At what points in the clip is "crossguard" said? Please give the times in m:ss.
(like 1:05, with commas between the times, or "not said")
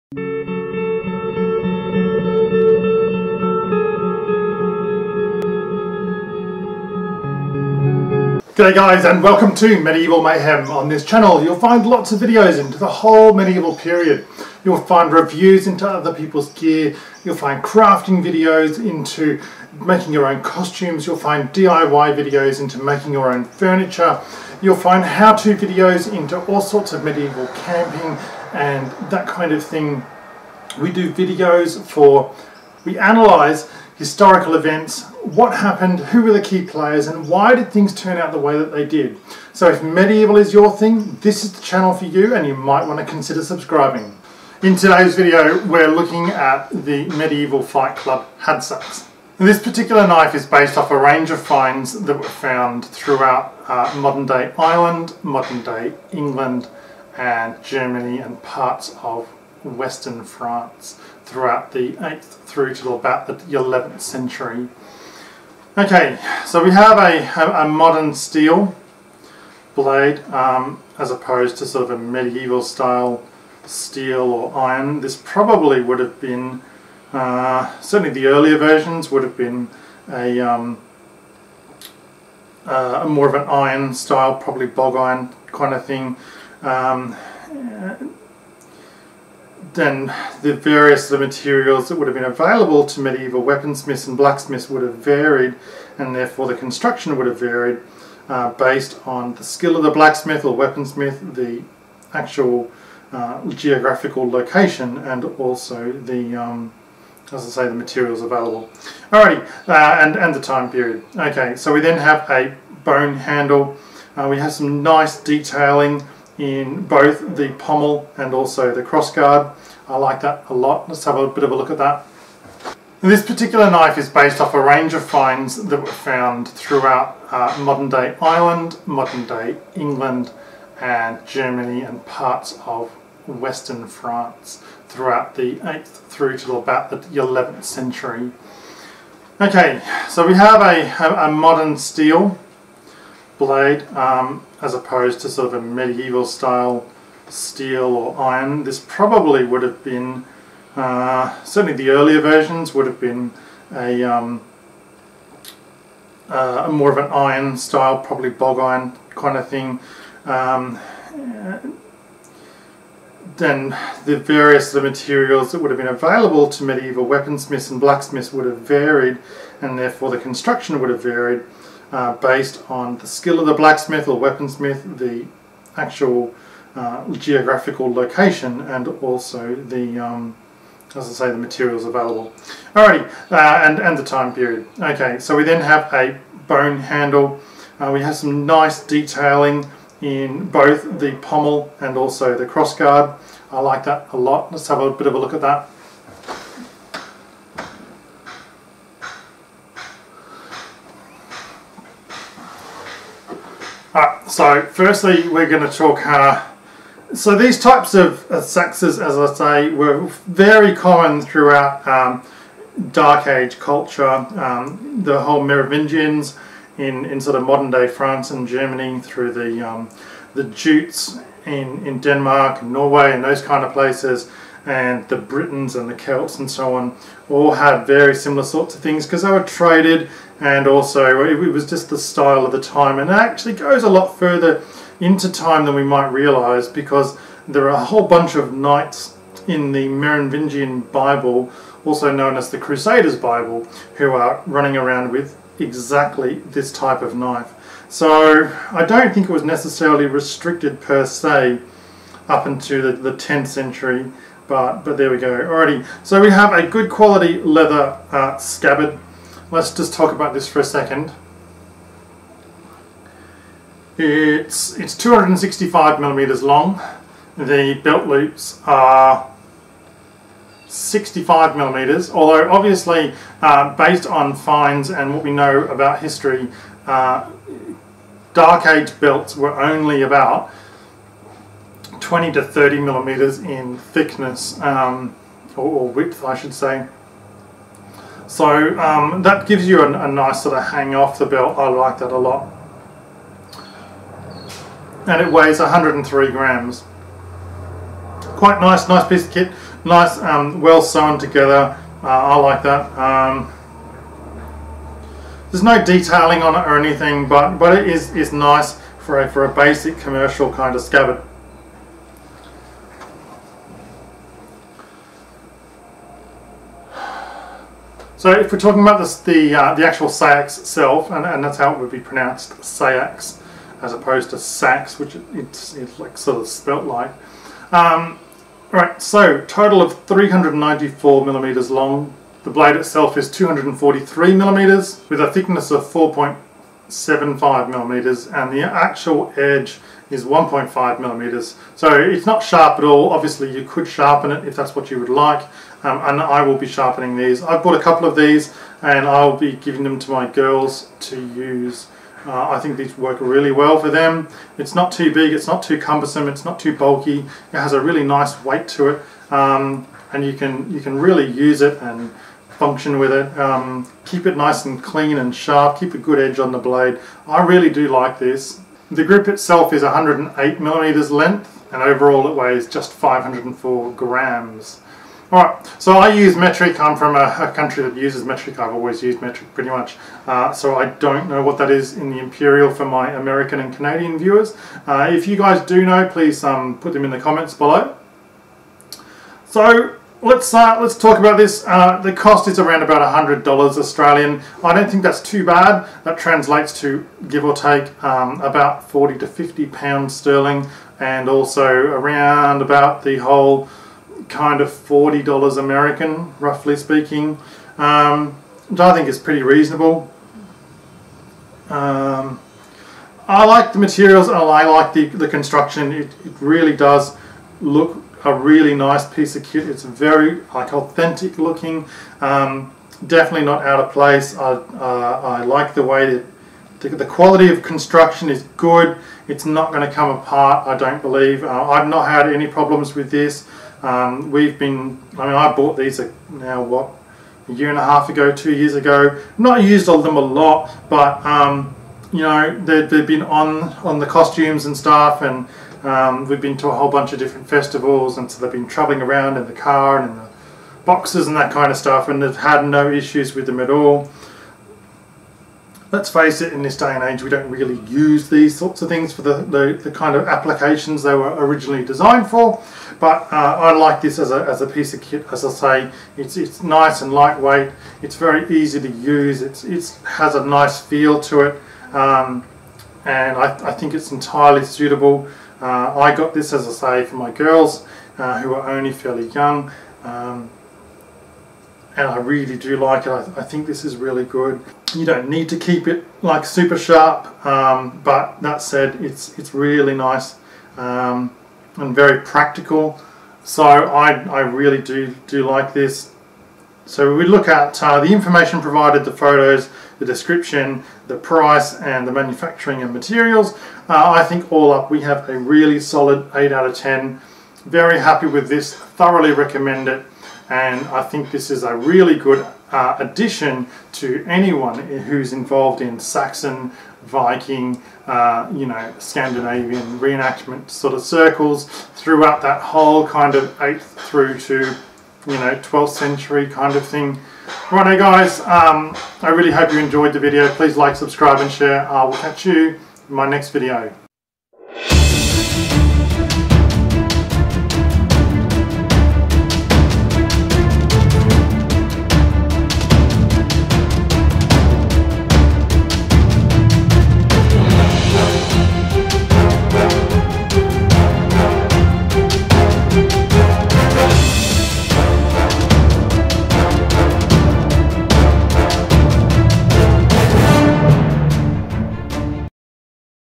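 1:58, 3:12.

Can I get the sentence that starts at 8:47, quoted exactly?
Righto guys, um, I really hope you enjoyed the video.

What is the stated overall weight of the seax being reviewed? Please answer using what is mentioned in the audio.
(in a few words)
504 grams.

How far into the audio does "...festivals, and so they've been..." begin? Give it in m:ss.
7:27.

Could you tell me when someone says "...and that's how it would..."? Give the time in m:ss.
5:21.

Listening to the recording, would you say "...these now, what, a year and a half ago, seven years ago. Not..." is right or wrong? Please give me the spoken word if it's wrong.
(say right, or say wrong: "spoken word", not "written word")
wrong: "two", not "seven".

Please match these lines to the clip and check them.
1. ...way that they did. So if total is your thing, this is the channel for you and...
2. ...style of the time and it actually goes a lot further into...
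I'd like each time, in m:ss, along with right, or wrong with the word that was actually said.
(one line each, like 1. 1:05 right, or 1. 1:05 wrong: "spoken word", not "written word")
1. 0:38 wrong: "medieval", not "total"
2. 3:51 right.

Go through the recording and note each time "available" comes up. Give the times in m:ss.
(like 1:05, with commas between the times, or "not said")
1:32, 1:48, 2:45, 3:01.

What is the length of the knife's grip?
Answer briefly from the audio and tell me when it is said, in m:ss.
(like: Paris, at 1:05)
108 millimeters, at 6:09.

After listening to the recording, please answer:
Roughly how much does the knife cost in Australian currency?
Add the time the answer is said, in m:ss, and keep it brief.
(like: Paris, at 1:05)
100 dollars Australian, at 6:33.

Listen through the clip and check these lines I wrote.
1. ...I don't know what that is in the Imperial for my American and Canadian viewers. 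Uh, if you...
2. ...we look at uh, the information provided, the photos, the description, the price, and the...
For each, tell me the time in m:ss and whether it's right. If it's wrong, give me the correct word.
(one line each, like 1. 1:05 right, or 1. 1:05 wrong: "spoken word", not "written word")
1. 6:20 right
2. 8:17 right.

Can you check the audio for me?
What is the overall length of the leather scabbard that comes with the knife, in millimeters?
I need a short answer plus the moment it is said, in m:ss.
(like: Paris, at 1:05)
265 millimeters, at 4:24.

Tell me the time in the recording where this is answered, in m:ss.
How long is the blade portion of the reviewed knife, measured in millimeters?
5:33.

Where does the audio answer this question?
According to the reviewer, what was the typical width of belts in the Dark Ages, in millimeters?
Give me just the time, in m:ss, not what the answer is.
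4:42.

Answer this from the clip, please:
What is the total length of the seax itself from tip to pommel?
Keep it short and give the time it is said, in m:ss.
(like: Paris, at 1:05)
394 millimeters, at 5:30.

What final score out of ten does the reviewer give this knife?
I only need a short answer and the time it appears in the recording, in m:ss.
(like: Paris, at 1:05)
8 out of 10, at 8:26.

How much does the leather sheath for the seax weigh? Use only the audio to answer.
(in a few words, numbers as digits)
103 grams.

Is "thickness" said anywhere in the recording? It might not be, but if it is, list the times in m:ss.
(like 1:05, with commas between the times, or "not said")
4:43, 5:35.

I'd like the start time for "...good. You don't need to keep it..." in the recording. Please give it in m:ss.
8:04.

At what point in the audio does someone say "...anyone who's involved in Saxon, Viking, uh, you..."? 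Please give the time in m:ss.
8:34.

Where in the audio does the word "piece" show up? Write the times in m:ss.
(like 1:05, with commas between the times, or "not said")
4:59, 6:59, 7:44.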